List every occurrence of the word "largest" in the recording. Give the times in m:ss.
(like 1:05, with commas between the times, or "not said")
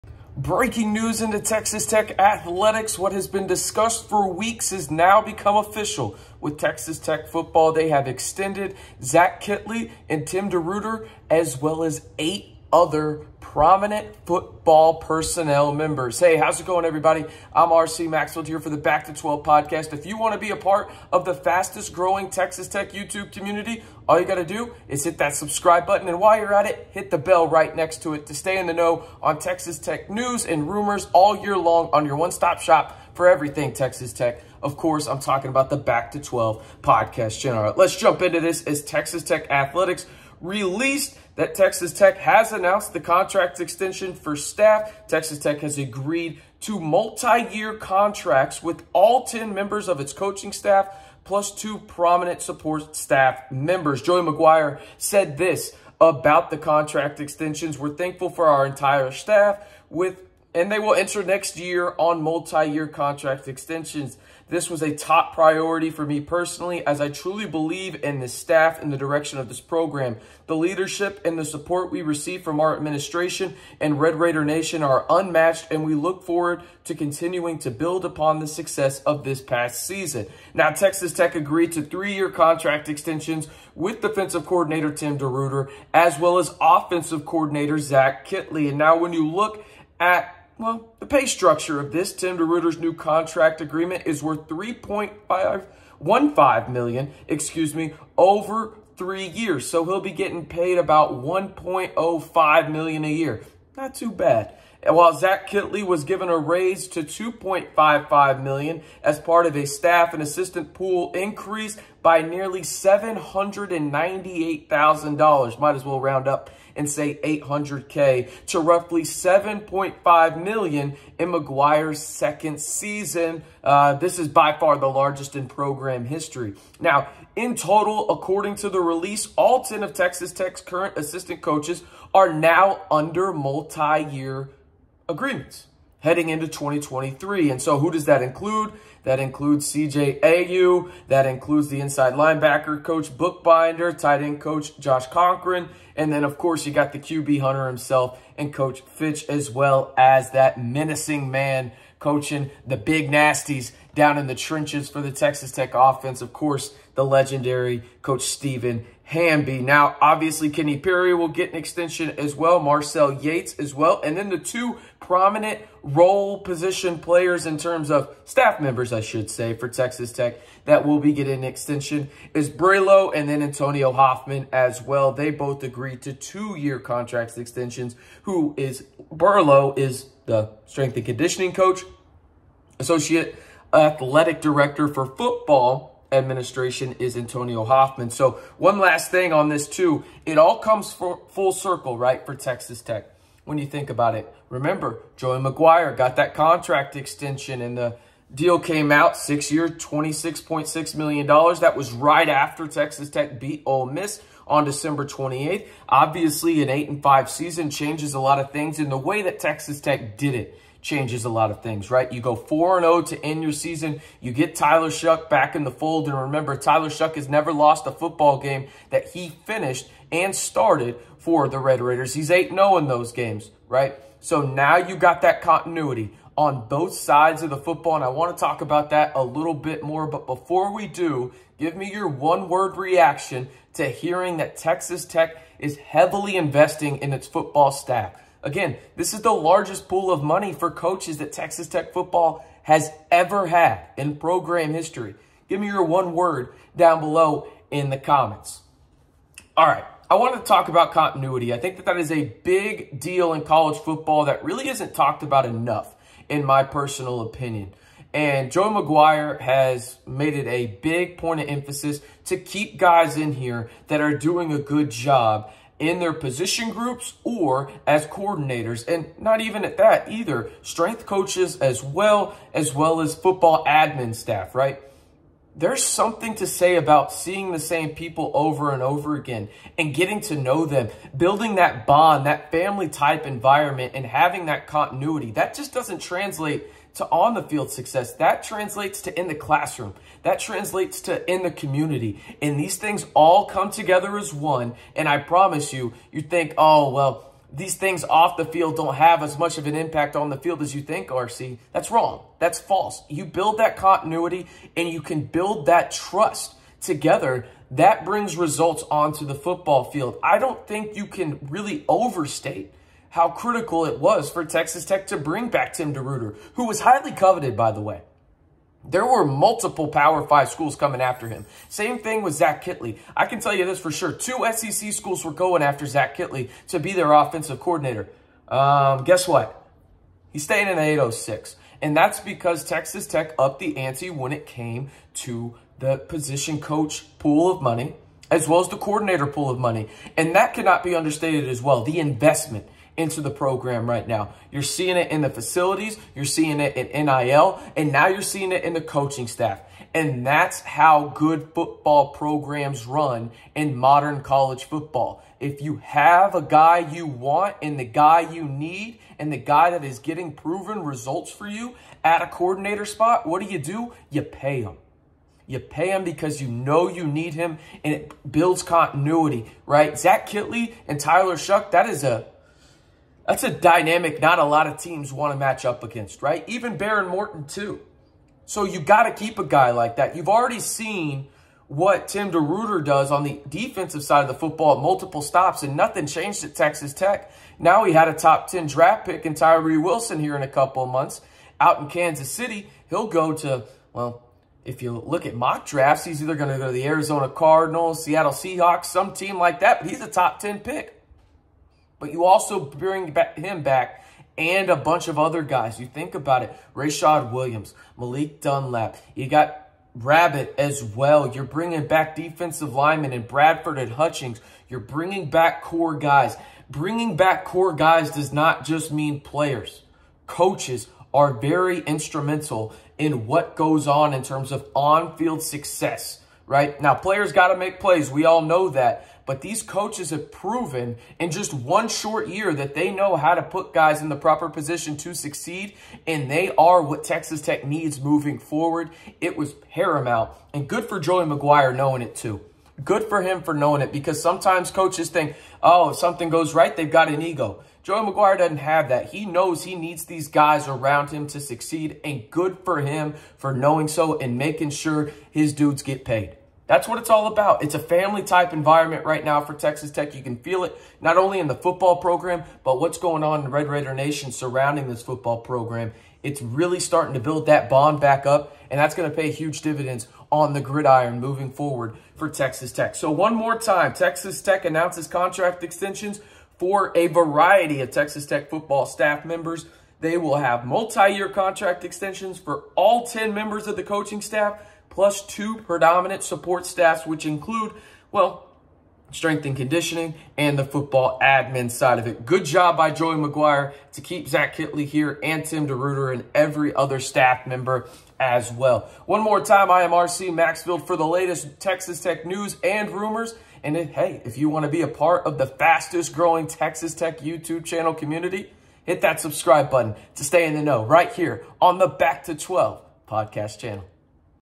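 2:04, 3:59.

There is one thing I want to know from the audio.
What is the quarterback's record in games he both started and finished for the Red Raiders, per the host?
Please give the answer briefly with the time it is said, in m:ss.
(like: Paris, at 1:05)
8-0, at 3:42.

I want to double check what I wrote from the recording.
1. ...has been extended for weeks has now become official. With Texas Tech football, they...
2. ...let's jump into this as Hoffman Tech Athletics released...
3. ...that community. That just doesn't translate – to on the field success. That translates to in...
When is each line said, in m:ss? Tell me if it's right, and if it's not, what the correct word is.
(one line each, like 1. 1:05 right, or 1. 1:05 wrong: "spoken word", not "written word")
1. 0:03 wrong: "discussed", not "extended"
2. 0:37 wrong: "Texas", not "Hoffman"
3. 4:44 wrong: "continuity", not "community".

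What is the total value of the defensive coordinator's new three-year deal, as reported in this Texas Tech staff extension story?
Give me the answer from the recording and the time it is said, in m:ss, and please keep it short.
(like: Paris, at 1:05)
3.515 million, at 1:34.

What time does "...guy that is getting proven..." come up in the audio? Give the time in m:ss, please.
5:59.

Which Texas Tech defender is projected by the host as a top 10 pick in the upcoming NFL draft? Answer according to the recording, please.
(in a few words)
Tyree Wilson.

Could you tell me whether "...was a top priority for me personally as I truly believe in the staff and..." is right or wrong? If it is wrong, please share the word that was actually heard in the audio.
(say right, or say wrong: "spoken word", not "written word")
right.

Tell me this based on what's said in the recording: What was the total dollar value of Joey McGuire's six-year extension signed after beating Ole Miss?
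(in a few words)
$26.6 million.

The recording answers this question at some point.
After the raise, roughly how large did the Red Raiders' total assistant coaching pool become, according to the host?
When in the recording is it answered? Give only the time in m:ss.
1:59.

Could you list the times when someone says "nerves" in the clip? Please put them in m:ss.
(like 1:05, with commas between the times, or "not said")
not said.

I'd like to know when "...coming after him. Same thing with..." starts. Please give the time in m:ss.
5:20.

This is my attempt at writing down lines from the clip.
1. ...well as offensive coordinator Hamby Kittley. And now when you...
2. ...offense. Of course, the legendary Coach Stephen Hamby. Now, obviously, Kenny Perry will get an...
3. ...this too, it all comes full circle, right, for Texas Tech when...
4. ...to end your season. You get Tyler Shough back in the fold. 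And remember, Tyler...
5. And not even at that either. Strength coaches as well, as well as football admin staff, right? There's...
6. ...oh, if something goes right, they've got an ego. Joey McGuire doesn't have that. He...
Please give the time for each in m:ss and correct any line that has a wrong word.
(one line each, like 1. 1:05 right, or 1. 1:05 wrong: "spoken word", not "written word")
1. 1:26 wrong: "Zach", not "Hamby"
2. 2:35 right
3. 3:09 right
4. 3:33 right
5. 4:28 right
6. 7:25 right.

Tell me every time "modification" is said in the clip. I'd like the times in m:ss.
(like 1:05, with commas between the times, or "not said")
not said.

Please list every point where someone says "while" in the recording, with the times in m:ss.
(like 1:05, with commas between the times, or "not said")
0:26, 1:44.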